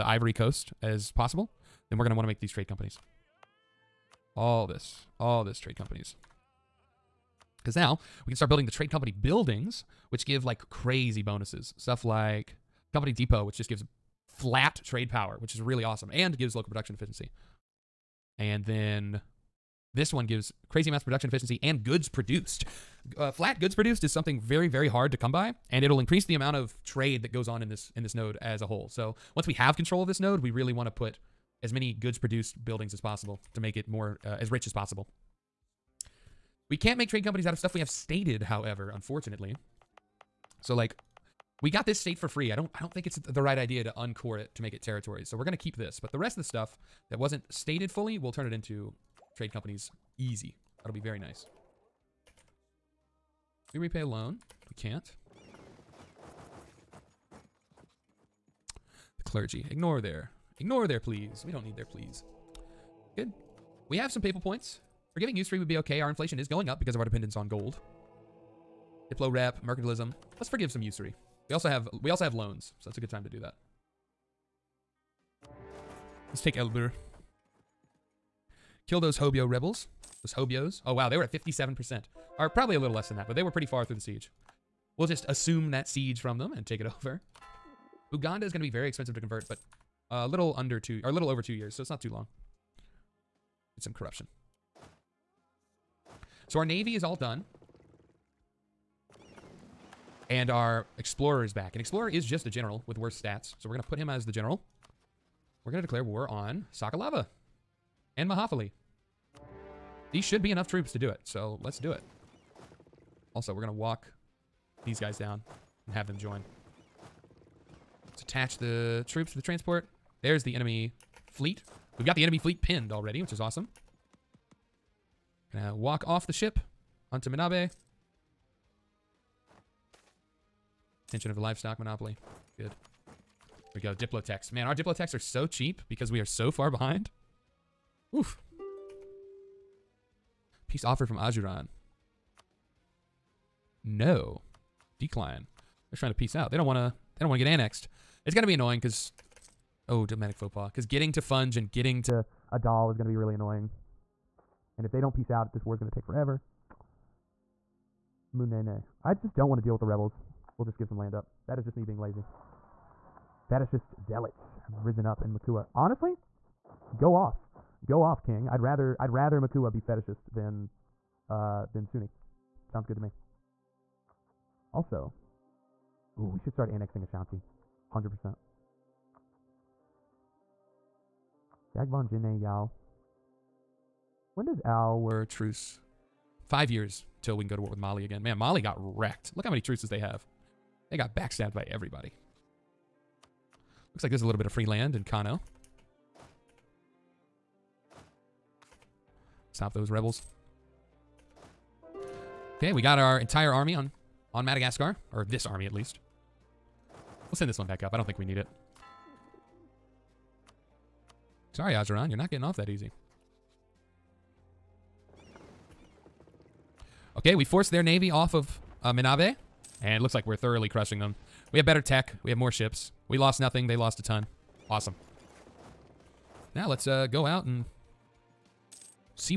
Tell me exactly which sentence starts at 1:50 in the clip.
These should be enough troops to do it.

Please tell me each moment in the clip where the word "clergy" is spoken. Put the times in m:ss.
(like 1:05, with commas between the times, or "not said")
0:59.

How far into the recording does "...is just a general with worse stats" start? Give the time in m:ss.
1:42.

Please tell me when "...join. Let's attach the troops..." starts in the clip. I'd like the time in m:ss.
1:56.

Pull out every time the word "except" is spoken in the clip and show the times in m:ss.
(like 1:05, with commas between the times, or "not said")
not said.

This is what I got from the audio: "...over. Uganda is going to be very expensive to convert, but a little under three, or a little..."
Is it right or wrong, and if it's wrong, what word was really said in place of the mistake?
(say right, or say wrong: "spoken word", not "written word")
wrong: "two", not "three".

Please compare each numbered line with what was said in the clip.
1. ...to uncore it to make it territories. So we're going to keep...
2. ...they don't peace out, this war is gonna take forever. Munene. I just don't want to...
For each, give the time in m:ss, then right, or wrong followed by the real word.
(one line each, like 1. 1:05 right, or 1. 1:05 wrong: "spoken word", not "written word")
1. 0:43 right
2. 2:34 right.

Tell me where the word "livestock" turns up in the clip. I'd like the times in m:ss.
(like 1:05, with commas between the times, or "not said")
2:11.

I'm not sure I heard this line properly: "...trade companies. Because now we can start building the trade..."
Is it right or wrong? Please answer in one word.
right.